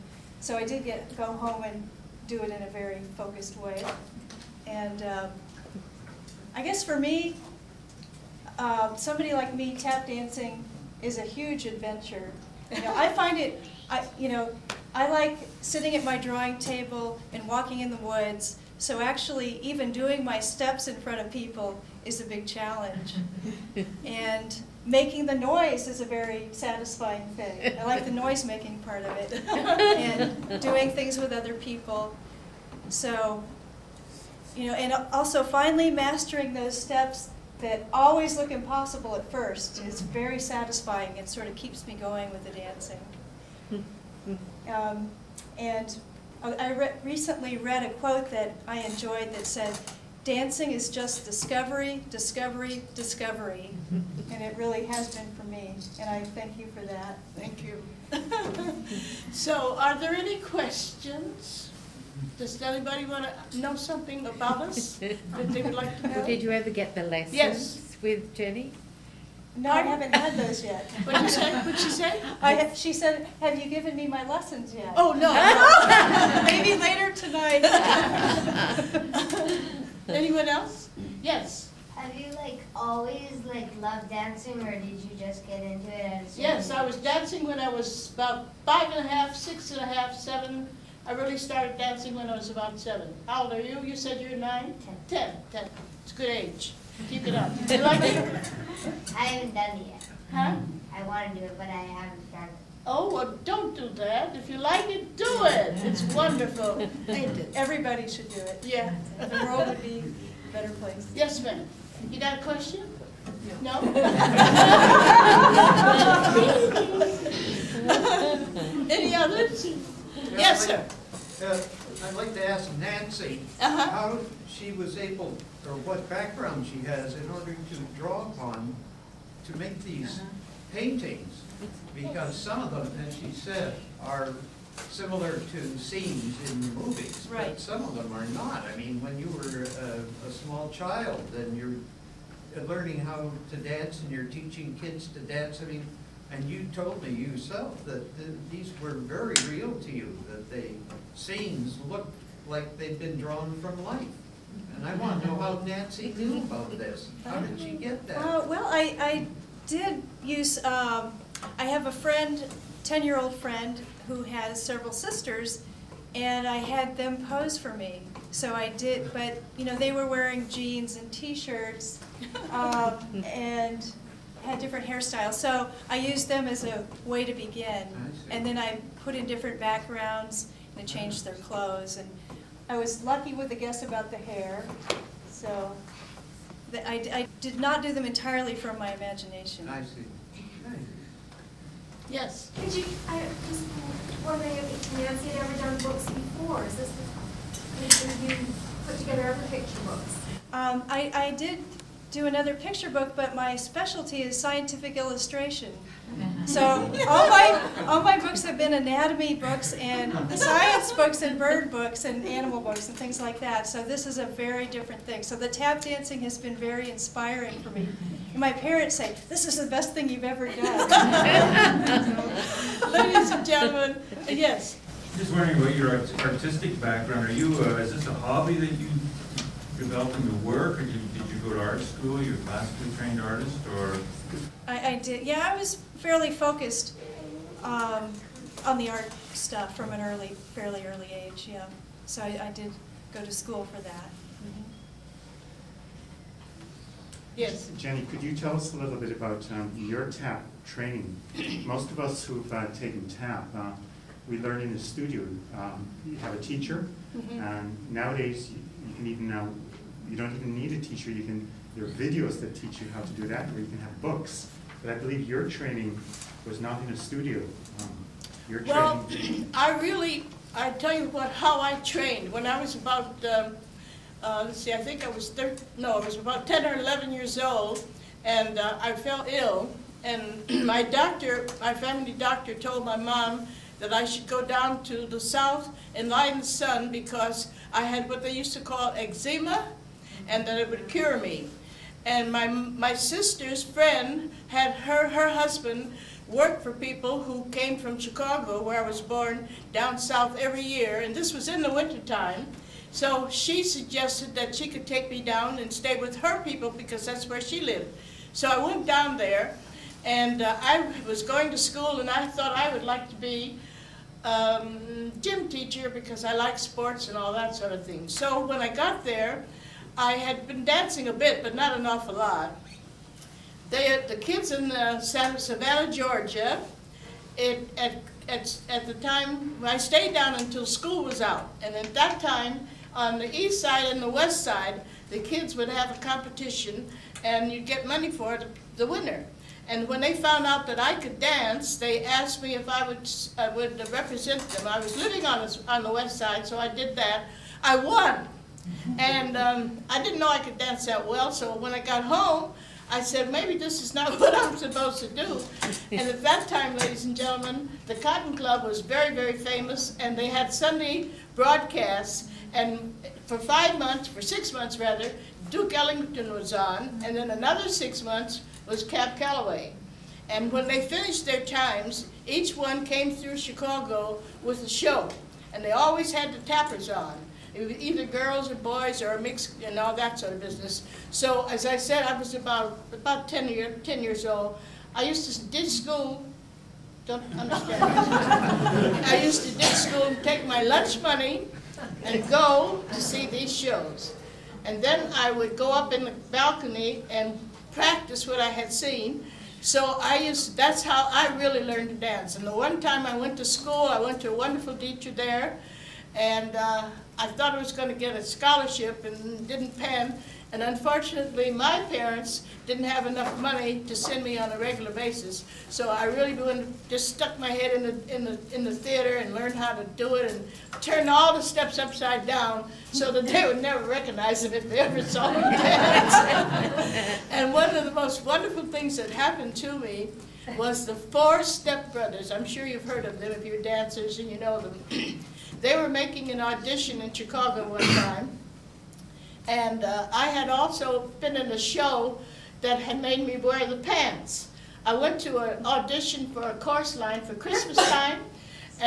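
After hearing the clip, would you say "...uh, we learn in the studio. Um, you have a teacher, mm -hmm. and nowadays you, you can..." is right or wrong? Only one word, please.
right.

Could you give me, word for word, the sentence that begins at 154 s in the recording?
And I want to know how Nancy knew about this.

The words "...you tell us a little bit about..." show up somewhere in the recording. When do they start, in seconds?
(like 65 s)
248 s.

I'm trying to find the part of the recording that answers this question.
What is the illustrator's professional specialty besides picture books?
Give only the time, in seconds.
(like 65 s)
204 s.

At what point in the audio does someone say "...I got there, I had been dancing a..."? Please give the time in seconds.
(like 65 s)
318 s.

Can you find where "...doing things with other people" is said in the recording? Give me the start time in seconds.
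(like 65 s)
30 s.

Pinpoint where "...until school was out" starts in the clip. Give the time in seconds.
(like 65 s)
330 s.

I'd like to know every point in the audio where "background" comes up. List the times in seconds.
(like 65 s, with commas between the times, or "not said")
126 s, 179 s, 226 s.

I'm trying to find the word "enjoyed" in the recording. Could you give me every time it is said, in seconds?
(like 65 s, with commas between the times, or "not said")
48 s.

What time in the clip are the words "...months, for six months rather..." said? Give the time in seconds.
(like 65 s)
363 s.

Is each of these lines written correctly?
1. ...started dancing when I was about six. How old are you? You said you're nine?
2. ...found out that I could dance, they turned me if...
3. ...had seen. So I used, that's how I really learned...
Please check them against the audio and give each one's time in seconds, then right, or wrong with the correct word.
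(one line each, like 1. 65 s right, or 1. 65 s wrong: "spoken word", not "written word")
1. 91 s wrong: "seven", not "six"
2. 340 s wrong: "asked", not "turned"
3. 398 s right.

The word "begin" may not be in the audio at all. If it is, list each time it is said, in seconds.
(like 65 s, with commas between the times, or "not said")
177 s.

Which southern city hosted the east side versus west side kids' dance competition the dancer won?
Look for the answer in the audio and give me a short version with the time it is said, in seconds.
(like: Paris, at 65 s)
Savannah, Georgia, at 324 s.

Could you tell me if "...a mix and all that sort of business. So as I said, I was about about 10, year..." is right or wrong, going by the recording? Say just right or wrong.
right.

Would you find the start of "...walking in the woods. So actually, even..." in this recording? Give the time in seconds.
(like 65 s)
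17 s.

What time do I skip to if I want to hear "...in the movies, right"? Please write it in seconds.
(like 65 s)
136 s.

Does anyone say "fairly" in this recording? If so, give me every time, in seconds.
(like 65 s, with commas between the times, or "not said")
235 s, 240 s.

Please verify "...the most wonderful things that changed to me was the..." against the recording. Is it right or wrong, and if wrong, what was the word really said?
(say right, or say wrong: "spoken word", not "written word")
wrong: "happened", not "changed".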